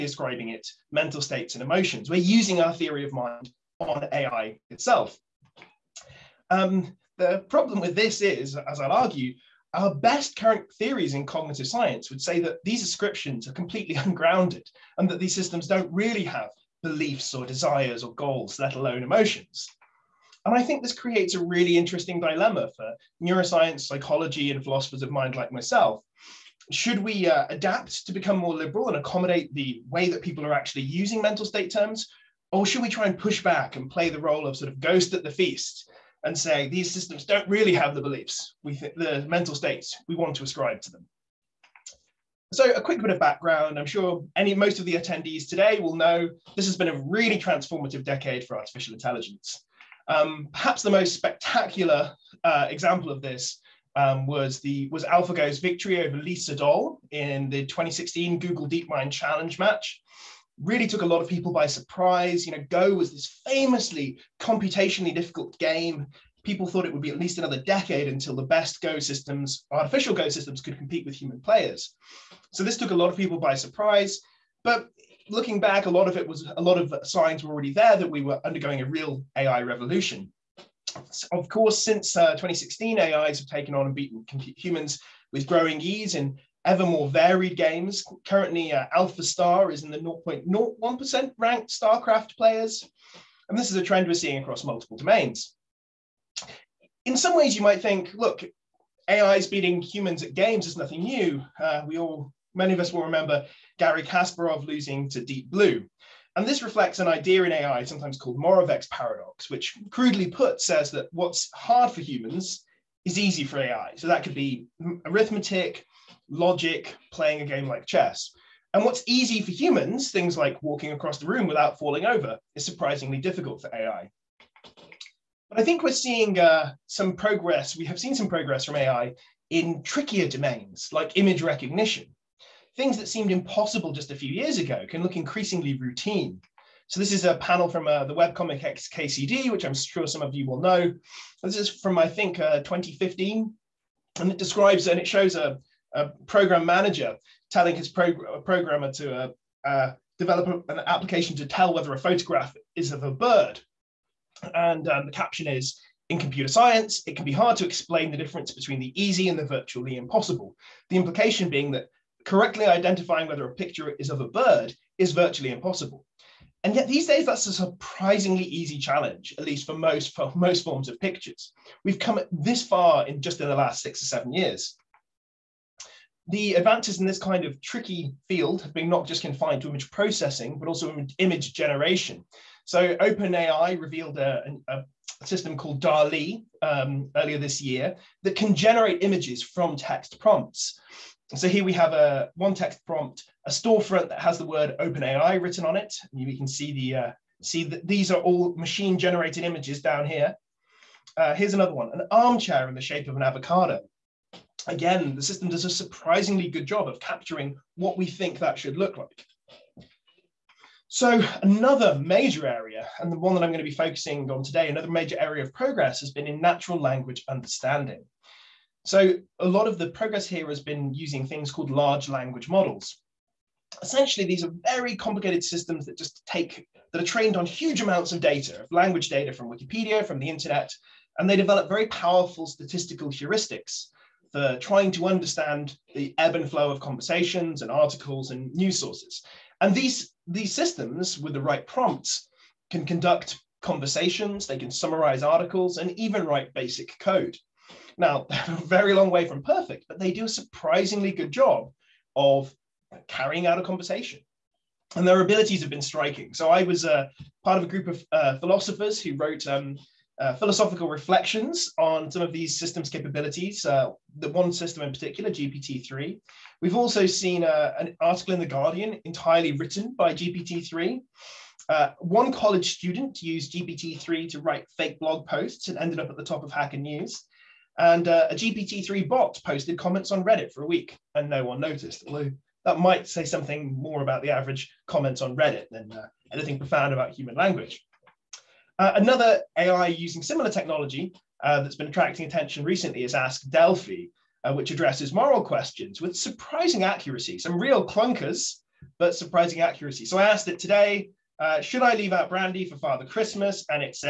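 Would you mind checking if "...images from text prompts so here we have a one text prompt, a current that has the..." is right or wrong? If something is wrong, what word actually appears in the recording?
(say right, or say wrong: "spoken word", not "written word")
wrong: "storefront", not "current".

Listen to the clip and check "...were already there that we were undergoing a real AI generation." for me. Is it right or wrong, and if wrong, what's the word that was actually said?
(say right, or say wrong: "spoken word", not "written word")
wrong: "revolution", not "generation".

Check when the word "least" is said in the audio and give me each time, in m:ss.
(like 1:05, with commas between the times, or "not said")
1:07, 2:49.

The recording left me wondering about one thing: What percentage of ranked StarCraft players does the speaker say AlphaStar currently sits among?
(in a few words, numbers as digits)
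0.01%.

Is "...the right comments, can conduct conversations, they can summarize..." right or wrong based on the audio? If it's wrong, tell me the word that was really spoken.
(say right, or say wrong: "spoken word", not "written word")
wrong: "prompts", not "comments".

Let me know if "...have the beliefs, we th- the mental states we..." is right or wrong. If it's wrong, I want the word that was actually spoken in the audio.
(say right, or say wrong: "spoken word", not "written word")
right.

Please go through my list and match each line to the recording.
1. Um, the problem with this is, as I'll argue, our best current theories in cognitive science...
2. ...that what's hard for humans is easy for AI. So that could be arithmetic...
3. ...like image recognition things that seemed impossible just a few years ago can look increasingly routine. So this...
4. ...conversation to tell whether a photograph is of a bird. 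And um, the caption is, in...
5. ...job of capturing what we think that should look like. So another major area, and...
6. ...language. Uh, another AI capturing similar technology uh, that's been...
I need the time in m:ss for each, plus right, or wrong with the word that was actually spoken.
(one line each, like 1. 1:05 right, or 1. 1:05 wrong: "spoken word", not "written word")
1. 0:06 right
2. 1:50 right
3. 2:10 right
4. 2:30 wrong: "application", not "conversation"
5. 3:26 right
6. 4:47 wrong: "using", not "capturing".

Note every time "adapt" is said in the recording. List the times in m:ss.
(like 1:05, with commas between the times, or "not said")
0:27.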